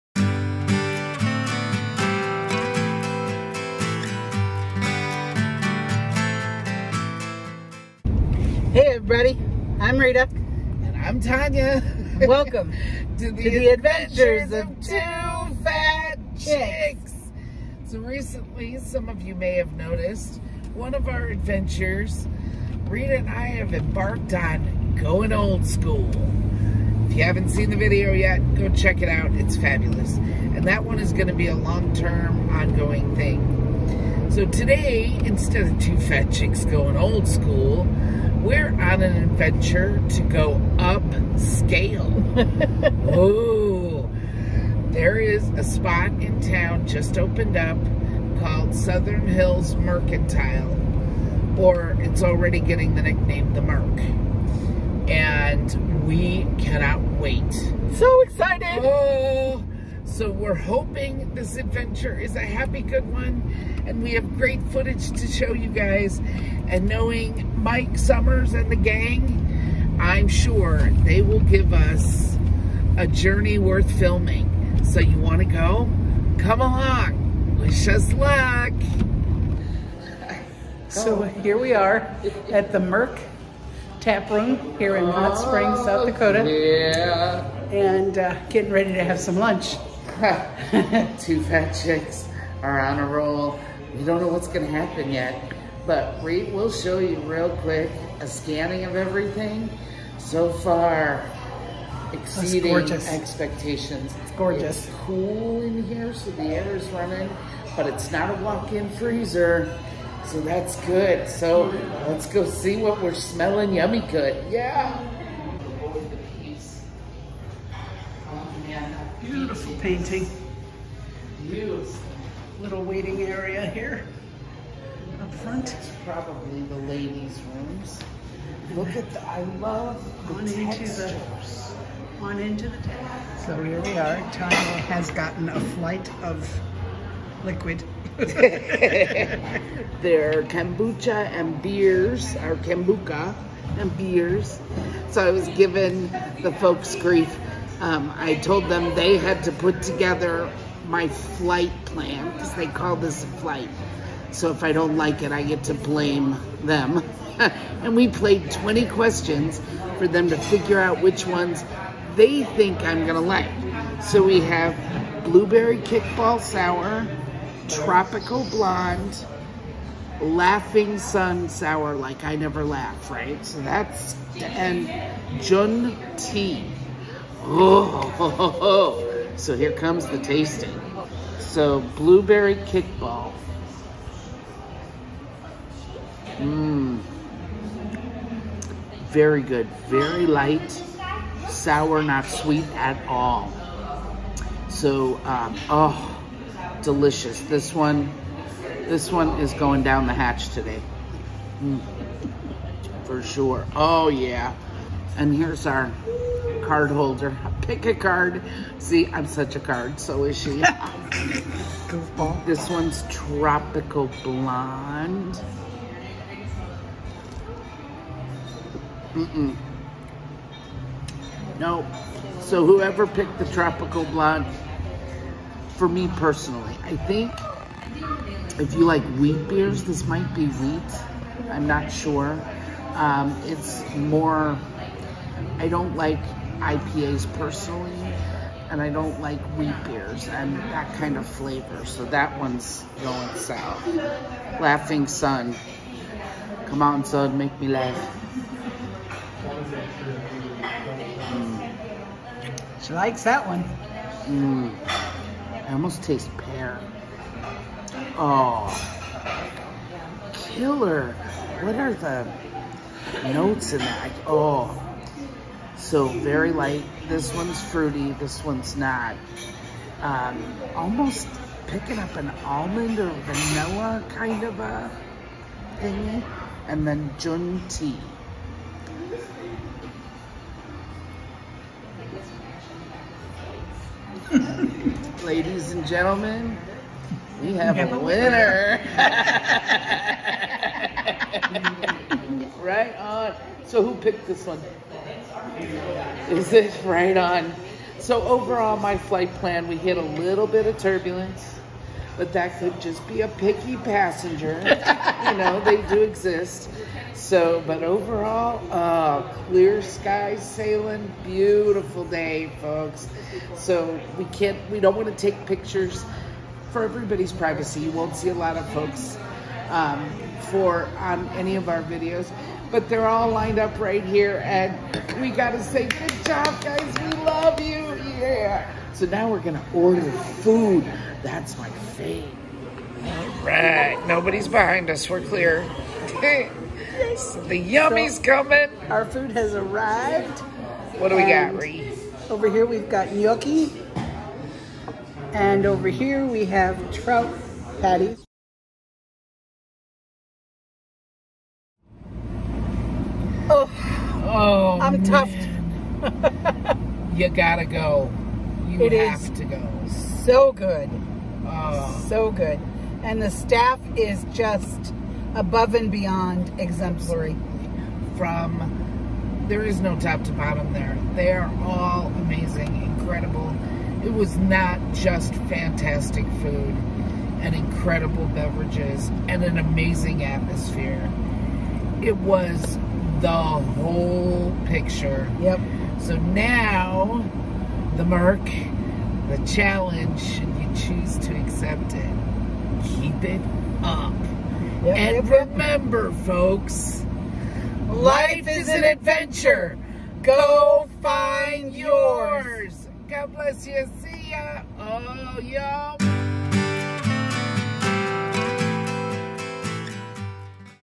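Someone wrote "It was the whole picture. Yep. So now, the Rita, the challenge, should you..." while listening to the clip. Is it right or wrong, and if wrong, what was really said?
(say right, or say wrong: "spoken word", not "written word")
wrong: "Merc", not "Rita".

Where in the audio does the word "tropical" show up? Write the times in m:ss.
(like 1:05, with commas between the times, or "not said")
2:47, 3:33, 3:43.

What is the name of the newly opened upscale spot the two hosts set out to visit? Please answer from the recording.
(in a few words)
Southern Hills Mercantile.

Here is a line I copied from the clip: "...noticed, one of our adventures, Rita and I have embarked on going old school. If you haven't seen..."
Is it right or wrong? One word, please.
right.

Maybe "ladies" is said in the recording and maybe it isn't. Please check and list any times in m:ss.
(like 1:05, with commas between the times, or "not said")
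2:06, 4:45.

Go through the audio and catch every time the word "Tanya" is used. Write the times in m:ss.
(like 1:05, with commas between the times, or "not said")
0:11, 2:14.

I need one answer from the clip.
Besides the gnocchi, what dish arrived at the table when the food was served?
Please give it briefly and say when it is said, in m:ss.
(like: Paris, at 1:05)
Trout patties, at 5:46.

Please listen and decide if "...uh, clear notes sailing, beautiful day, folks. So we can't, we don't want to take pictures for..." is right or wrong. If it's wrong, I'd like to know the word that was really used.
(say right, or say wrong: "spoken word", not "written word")
wrong: "skies", not "notes".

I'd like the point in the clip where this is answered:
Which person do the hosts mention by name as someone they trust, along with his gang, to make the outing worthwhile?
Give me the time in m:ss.
1:07.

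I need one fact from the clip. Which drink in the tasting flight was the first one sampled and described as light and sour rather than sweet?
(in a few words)
Blueberry kickball sour.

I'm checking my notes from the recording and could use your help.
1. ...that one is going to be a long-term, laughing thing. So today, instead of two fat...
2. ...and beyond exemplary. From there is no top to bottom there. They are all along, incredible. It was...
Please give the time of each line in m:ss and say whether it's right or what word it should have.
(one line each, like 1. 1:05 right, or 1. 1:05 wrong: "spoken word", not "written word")
1. 0:30 wrong: "ongoing", not "laughing"
2. 6:05 wrong: "amazing", not "along".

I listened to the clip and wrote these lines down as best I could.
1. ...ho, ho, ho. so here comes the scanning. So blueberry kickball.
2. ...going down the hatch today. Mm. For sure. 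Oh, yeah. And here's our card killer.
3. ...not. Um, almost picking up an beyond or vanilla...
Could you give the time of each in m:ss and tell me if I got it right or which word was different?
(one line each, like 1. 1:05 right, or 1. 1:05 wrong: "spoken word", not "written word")
1. 2:58 wrong: "tasting", not "scanning"
2. 3:19 wrong: "holder", not "killer"
3. 4:28 wrong: "almond", not "beyond".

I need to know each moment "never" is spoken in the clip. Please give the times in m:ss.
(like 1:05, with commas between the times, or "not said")
2:52.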